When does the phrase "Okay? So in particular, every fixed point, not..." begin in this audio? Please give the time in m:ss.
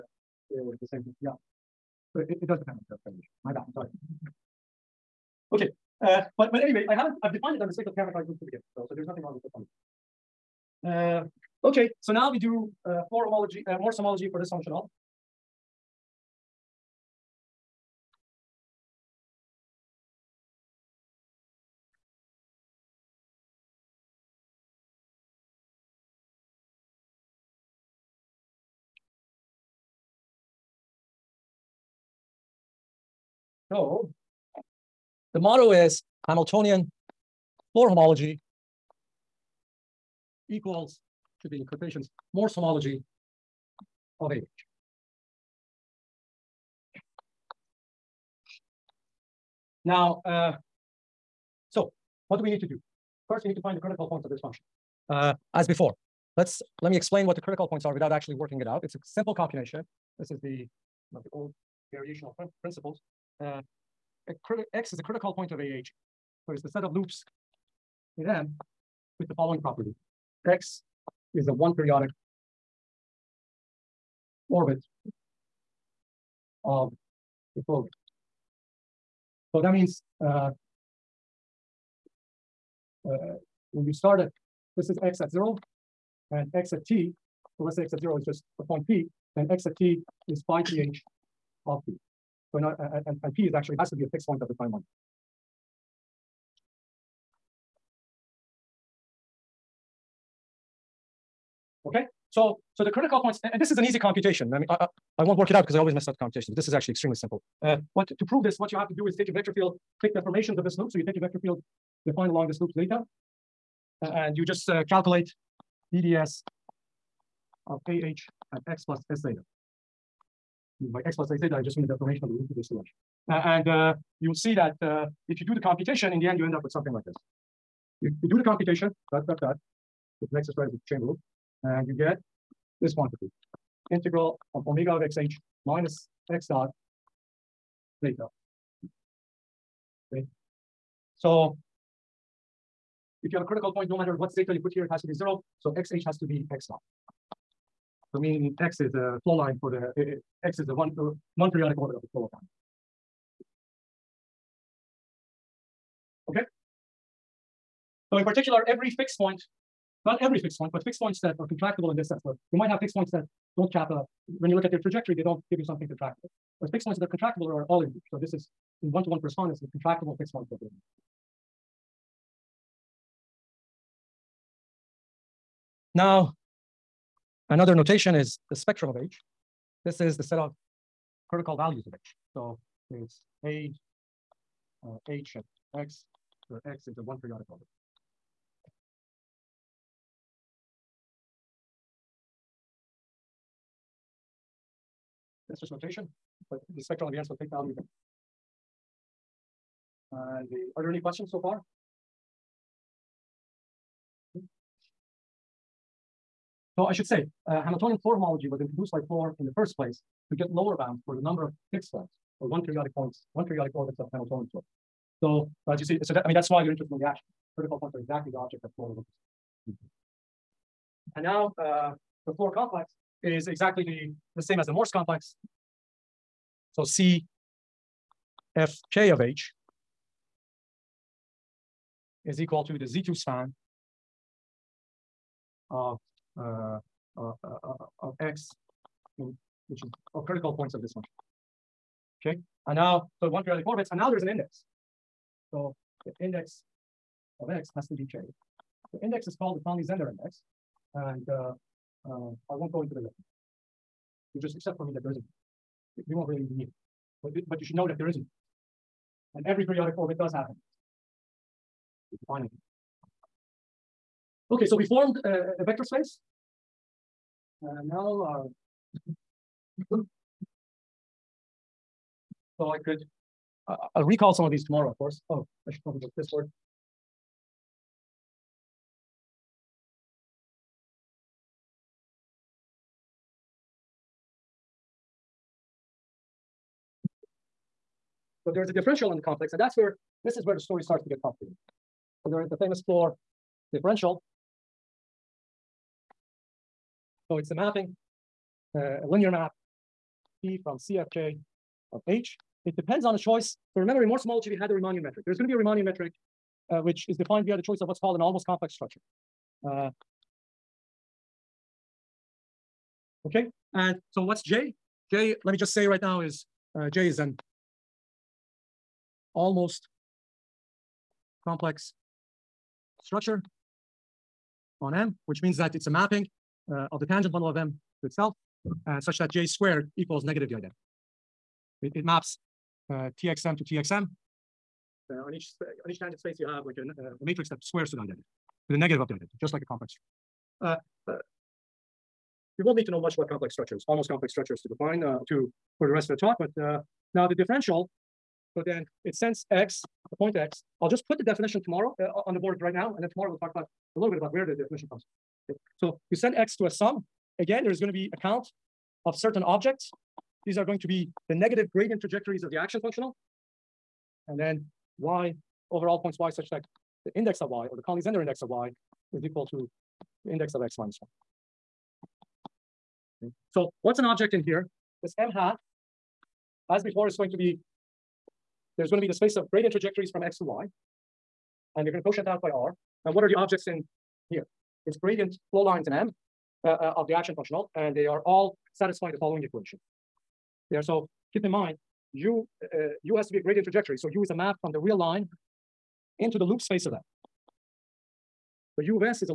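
2:36.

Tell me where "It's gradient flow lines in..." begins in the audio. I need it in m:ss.
6:24.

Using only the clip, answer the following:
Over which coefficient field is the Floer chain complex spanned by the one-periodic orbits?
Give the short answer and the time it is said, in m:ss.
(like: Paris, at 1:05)
Z2, at 3:52.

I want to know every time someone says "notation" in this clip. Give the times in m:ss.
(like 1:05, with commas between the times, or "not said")
2:57, 3:15.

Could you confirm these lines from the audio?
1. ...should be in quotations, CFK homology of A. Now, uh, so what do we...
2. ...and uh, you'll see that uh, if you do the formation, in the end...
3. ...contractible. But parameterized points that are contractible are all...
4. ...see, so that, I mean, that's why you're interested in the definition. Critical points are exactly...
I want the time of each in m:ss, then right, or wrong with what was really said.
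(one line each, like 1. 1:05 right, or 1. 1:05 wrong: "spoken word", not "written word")
1. 0:41 wrong: "Morse", not "CFK"
2. 2:03 wrong: "computation", not "formation"
3. 2:45 wrong: "fixed", not "parameterized"
4. 3:35 wrong: "action", not "definition".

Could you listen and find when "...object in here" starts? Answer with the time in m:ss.
6:14.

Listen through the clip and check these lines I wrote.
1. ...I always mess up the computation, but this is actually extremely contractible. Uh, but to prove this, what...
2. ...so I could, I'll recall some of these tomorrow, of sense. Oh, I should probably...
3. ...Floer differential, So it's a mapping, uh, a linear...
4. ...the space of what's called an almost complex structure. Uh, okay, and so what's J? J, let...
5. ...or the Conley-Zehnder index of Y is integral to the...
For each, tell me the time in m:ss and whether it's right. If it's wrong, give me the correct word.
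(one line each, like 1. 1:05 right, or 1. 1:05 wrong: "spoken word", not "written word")
1. 1:45 wrong: "simple", not "contractible"
2. 4:32 wrong: "course", not "sense"
3. 4:52 right
4. 5:07 wrong: "choice", not "space"
5. 6:07 wrong: "equal", not "integral".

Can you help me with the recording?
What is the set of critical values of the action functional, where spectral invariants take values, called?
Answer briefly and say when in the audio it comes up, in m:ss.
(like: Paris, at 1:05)
spectrum of H, at 2:58.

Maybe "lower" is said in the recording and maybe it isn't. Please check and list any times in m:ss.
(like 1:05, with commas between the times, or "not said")
3:30.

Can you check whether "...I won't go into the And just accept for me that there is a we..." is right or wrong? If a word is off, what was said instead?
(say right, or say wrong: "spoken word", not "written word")
wrong: "You", not "And".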